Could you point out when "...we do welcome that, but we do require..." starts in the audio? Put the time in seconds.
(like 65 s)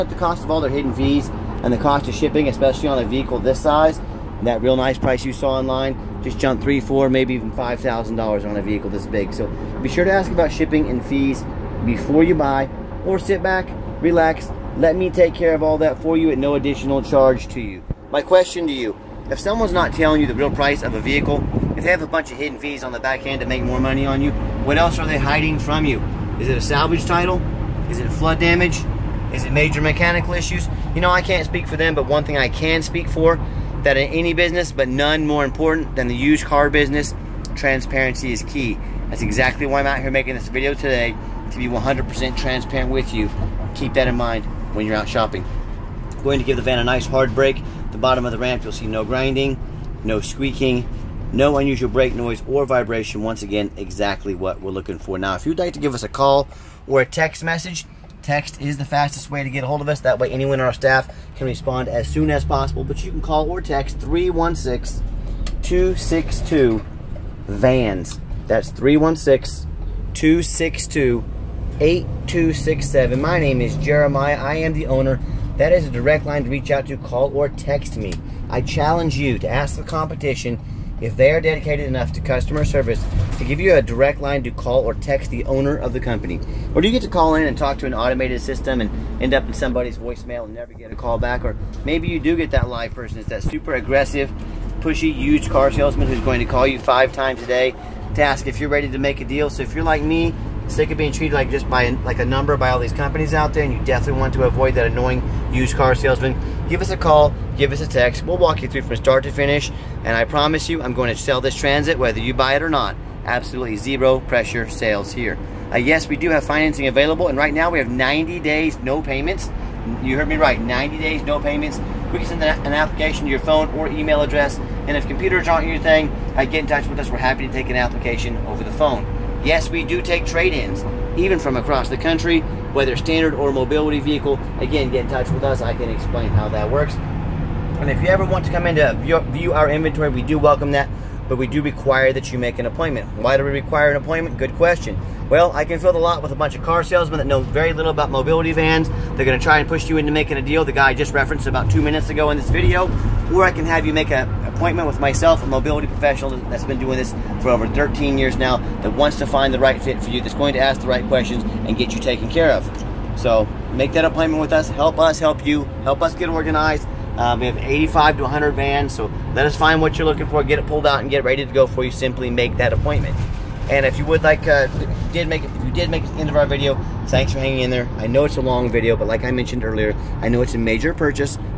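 140 s.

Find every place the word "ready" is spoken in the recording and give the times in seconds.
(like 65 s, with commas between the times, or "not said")
98 s, 171 s.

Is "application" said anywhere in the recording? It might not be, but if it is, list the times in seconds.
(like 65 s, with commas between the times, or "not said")
122 s, 127 s.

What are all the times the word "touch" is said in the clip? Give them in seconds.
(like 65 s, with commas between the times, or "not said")
126 s, 135 s.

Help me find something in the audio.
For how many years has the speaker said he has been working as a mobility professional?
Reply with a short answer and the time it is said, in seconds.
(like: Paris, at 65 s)
13, at 157 s.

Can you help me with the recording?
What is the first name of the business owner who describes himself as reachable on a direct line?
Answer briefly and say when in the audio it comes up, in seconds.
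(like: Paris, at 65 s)
Jeremiah, at 73 s.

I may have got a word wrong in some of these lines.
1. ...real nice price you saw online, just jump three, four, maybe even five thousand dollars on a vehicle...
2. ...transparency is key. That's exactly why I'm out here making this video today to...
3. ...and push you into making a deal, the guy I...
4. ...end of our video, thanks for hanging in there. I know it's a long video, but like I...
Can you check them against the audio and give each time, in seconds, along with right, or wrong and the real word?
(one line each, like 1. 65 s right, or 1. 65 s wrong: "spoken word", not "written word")
1. 4 s right
2. 37 s right
3. 149 s right
4. 176 s right.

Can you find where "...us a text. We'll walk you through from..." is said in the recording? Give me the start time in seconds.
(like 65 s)
107 s.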